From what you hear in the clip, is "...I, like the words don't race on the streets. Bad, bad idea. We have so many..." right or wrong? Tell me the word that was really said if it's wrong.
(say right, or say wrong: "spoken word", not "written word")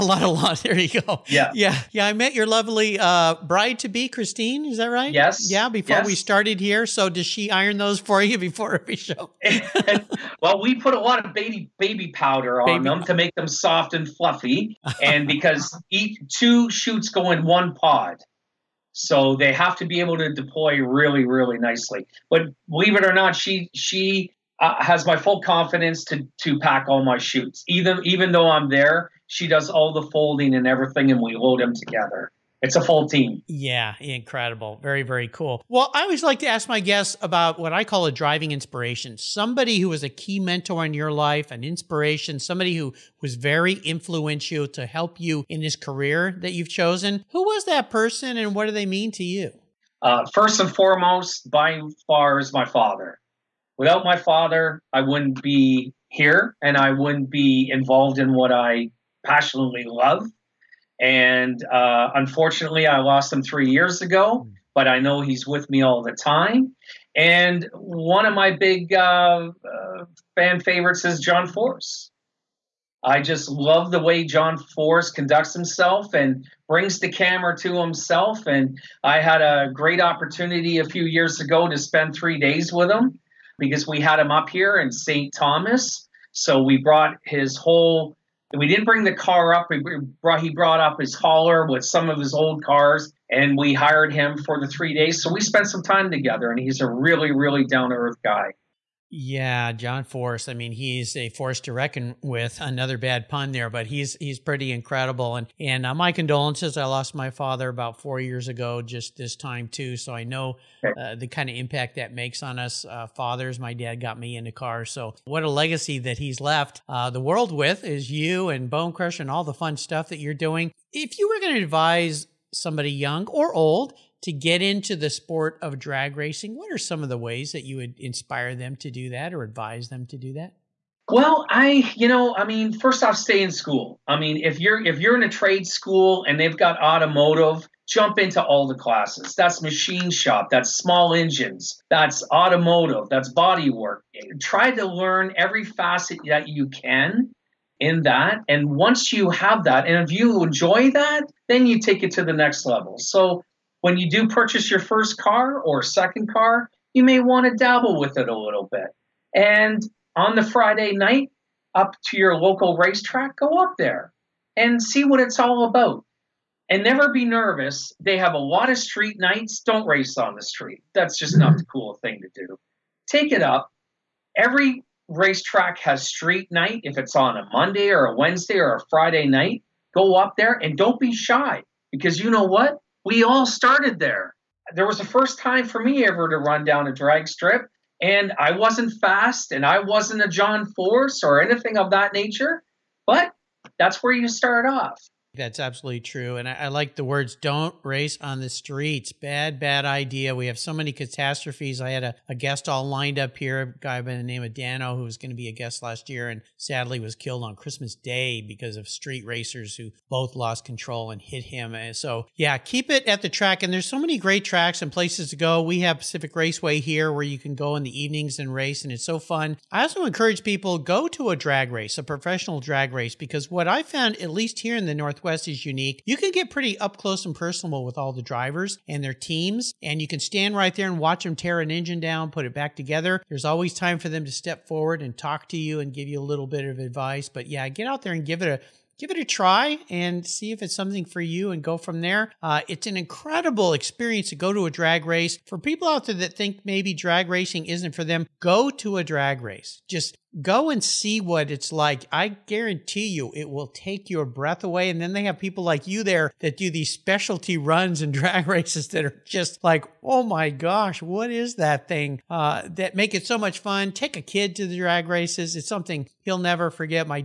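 right.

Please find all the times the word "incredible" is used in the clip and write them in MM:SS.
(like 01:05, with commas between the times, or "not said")
00:33, 01:44, 04:02.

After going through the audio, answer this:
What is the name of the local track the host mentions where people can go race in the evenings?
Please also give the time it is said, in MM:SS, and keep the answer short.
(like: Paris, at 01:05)
Pacific Raceway, at 03:35.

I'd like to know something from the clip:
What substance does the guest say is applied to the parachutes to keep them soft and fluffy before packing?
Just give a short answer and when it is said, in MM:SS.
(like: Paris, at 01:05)
Baby powder, at 00:11.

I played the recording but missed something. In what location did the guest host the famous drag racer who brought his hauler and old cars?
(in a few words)
St. Thomas.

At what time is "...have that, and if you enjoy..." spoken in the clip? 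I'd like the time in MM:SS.
02:29.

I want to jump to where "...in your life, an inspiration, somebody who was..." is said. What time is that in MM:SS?
00:40.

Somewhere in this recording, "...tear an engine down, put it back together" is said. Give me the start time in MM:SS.
03:51.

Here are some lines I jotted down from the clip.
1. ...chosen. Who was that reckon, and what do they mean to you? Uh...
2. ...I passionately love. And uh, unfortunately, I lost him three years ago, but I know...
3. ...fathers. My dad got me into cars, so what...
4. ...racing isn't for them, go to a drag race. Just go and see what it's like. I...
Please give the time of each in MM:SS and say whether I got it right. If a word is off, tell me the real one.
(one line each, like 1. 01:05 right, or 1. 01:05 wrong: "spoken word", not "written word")
1. 00:46 wrong: "person", not "reckon"
2. 00:58 right
3. 01:53 right
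4. 04:07 right.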